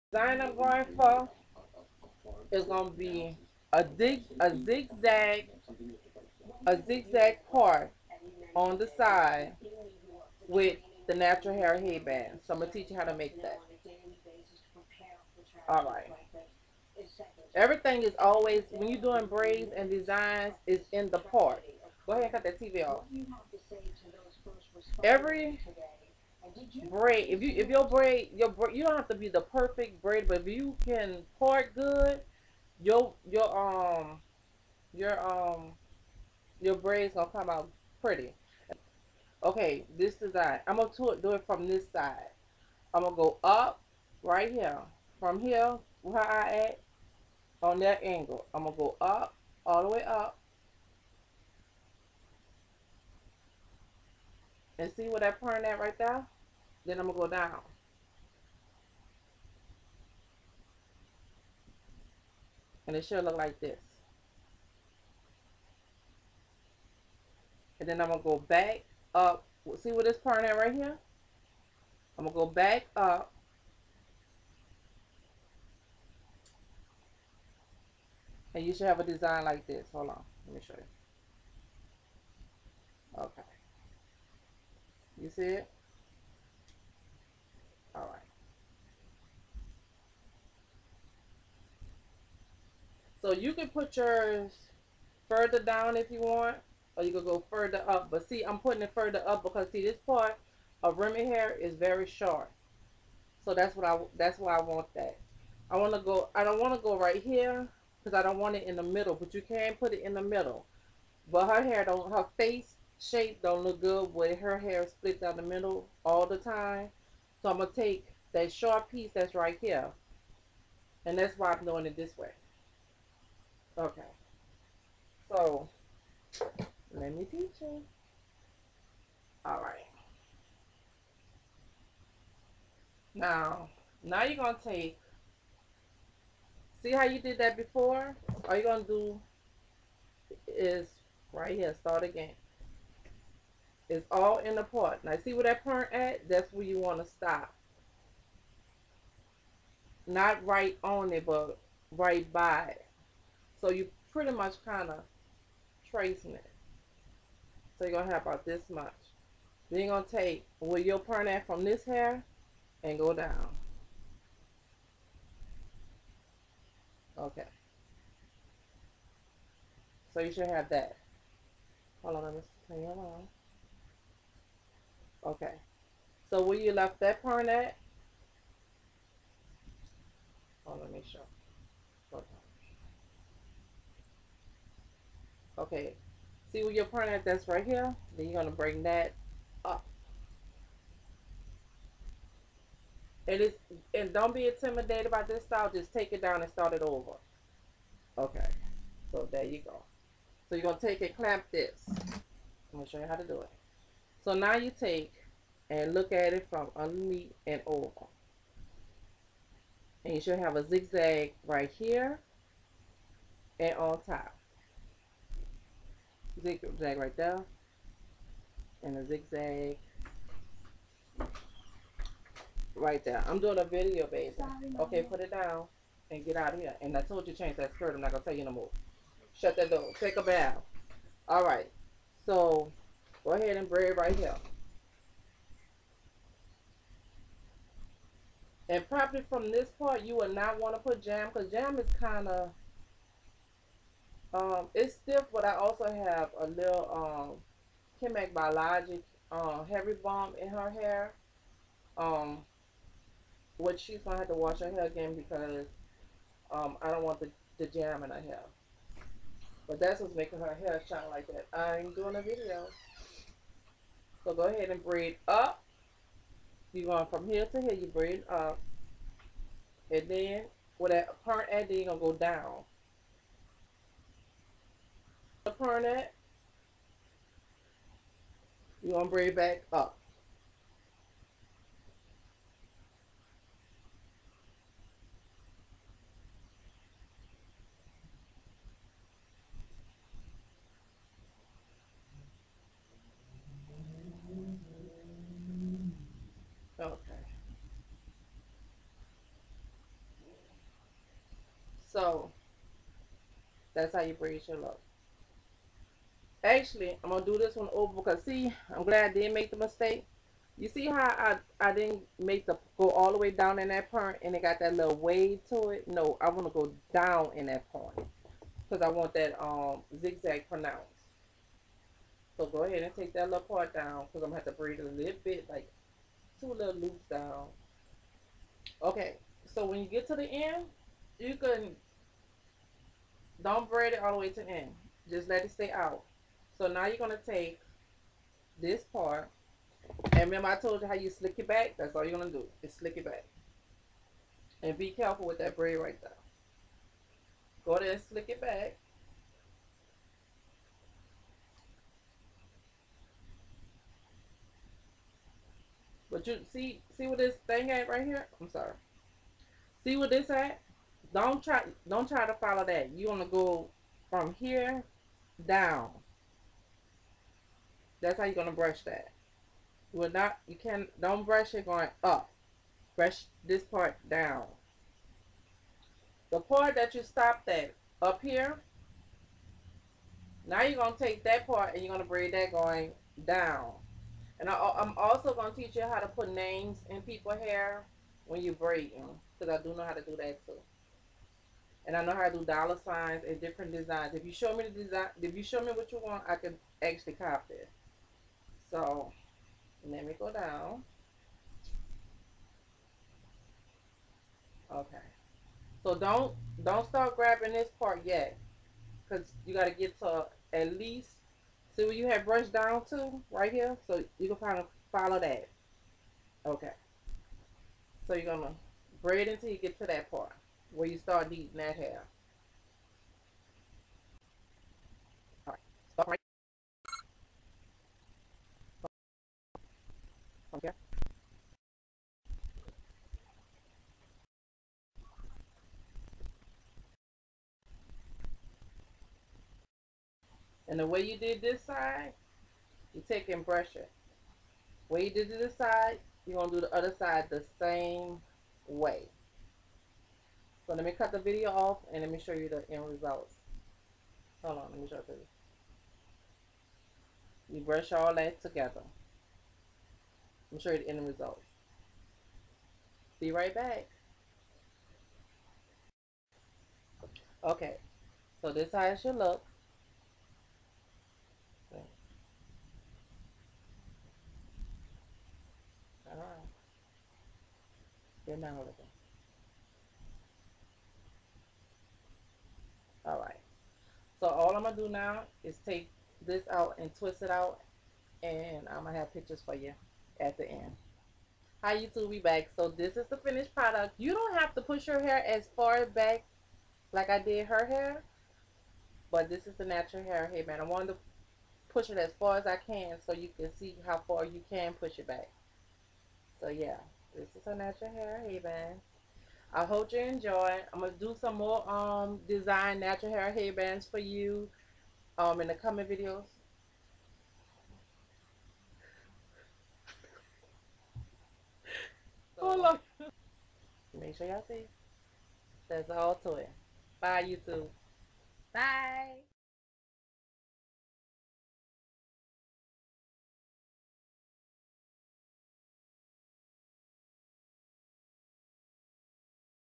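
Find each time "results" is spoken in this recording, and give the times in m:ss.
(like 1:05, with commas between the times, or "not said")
7:32, 7:41.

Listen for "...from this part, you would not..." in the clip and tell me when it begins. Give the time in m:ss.
3:59.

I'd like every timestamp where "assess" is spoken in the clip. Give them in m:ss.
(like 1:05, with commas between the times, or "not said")
not said.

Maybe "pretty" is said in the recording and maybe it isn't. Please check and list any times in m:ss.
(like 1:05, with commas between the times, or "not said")
0:38, 2:34.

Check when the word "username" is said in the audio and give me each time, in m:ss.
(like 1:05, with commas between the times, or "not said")
not said.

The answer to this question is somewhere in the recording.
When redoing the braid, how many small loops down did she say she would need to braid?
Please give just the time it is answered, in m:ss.
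5:26.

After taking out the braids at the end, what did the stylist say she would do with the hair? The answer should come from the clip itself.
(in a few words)
twist it out.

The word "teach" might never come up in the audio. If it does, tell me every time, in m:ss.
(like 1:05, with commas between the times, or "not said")
0:12, 2:07, 6:25.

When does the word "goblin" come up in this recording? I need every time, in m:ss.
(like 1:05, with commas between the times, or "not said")
not said.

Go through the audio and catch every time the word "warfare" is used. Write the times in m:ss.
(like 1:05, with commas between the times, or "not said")
not said.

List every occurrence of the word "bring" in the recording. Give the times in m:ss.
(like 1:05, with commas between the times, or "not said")
3:08.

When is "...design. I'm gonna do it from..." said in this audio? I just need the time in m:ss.
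0:40.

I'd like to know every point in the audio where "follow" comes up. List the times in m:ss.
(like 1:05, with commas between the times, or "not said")
6:02, 6:54.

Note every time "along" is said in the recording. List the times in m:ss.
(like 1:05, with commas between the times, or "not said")
2:52.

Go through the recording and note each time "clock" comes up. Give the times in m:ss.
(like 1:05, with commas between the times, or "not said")
not said.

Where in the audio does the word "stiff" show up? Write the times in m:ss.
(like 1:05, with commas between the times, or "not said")
4:04.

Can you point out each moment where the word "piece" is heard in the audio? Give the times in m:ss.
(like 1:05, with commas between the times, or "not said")
1:58.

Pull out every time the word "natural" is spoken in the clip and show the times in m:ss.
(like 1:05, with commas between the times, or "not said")
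0:11, 8:19, 8:27, 8:32.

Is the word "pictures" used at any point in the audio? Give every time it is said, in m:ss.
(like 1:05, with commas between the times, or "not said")
8:09.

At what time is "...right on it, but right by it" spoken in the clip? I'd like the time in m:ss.
2:30.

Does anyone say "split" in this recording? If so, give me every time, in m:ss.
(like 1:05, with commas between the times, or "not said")
1:54.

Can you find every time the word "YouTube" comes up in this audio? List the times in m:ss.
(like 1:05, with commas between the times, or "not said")
8:11, 8:47.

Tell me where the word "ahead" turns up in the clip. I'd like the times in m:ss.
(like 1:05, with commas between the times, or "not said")
0:22, 3:53, 4:24, 5:22.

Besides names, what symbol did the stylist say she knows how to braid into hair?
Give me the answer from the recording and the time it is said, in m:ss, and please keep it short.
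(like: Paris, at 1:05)
dollar signs, at 6:32.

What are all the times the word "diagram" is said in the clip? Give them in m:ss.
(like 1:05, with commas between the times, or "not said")
not said.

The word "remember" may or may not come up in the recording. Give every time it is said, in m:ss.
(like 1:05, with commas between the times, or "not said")
5:40.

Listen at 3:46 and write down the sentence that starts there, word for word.
And I told you change that skirt.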